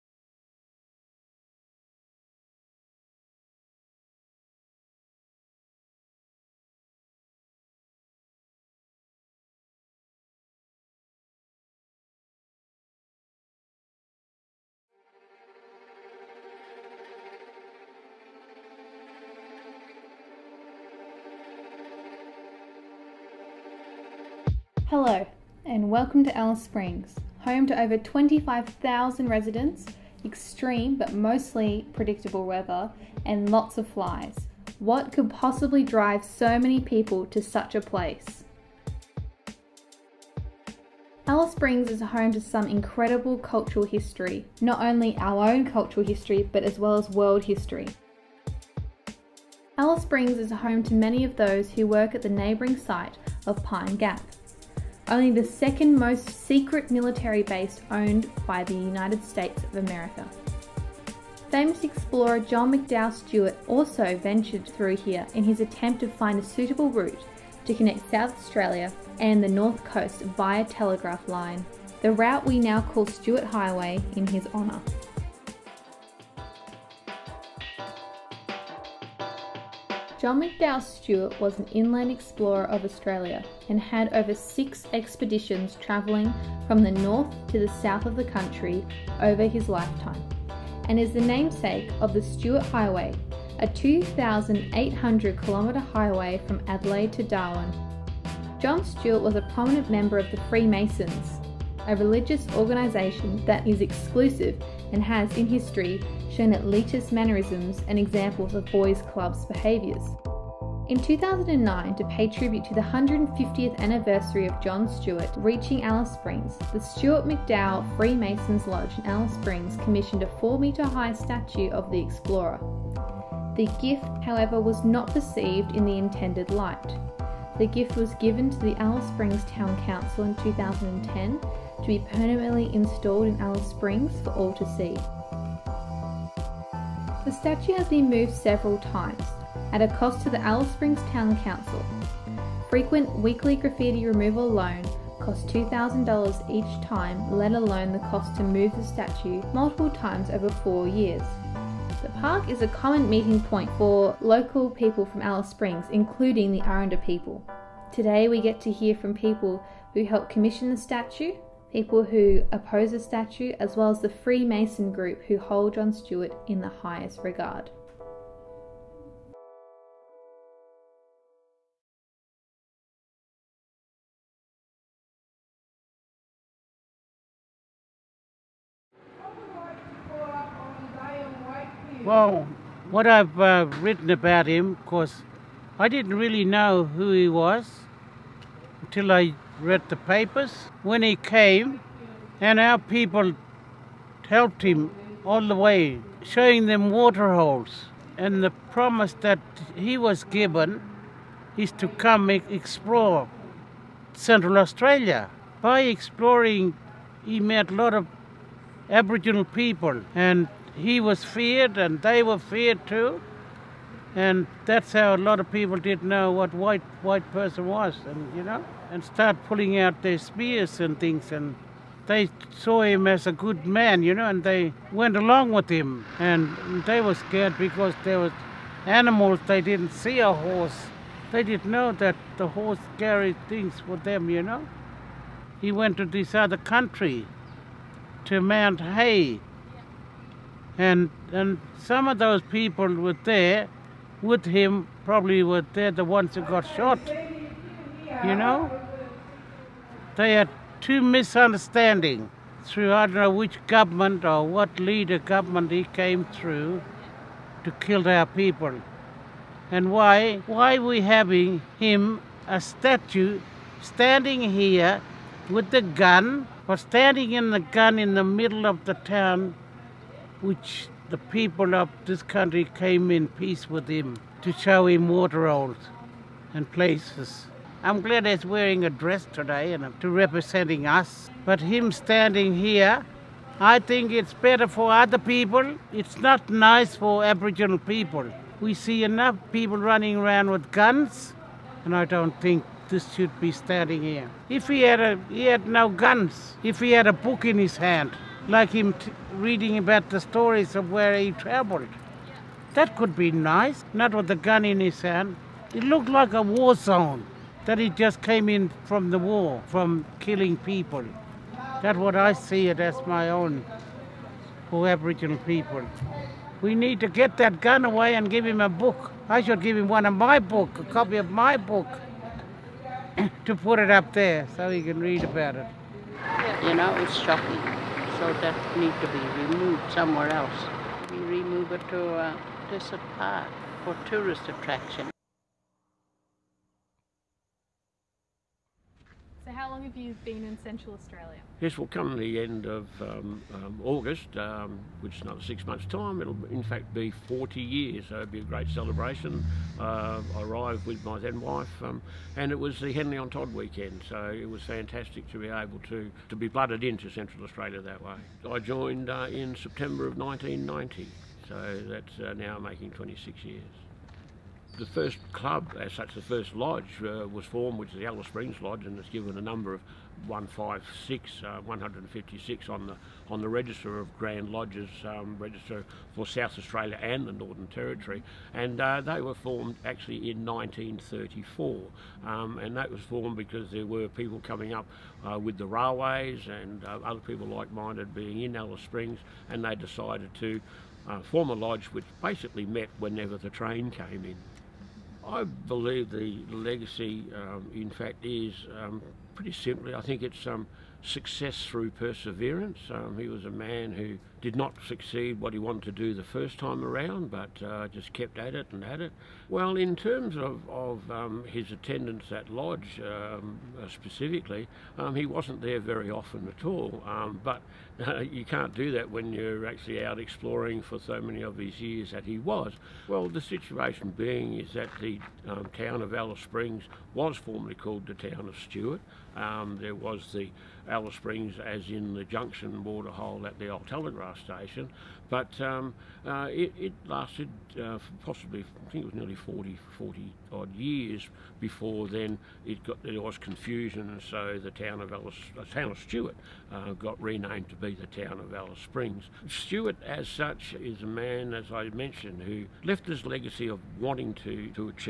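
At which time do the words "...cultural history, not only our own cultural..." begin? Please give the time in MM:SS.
00:43.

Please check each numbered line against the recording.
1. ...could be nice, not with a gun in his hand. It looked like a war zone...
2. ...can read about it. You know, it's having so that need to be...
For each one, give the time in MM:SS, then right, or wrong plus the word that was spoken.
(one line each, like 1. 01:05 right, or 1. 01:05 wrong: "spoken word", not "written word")
1. 05:02 right
2. 05:24 wrong: "shocking", not "having".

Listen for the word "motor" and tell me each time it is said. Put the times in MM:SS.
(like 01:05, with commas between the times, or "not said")
not said.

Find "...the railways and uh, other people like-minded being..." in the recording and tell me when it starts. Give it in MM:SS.
06:25.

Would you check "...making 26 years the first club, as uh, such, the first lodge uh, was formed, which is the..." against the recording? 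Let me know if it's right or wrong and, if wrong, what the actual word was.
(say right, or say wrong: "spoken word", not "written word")
right.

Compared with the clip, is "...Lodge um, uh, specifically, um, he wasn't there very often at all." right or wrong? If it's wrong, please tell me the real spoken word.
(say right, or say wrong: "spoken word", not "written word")
right.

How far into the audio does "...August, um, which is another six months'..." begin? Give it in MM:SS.
05:43.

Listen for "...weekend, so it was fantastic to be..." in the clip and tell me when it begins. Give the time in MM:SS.
05:53.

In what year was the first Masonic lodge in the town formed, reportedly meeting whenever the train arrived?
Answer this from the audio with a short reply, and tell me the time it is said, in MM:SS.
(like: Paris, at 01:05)
1934, at 06:20.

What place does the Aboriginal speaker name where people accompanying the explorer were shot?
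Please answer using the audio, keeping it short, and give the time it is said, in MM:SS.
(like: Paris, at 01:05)
Mount Hay, at 03:58.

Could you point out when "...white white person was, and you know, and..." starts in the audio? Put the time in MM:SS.
03:36.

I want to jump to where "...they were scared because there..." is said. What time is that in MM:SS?
03:46.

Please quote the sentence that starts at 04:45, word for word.
It's not nice for Aboriginal people.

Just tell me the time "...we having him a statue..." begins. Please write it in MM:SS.
04:20.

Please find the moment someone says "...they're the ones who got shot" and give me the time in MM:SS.
04:05.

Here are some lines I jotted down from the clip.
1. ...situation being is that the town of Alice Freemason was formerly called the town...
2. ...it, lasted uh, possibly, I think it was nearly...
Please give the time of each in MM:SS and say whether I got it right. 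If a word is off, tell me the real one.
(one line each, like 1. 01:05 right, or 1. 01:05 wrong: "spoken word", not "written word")
1. 07:03 wrong: "Springs", not "Freemason"
2. 07:16 right.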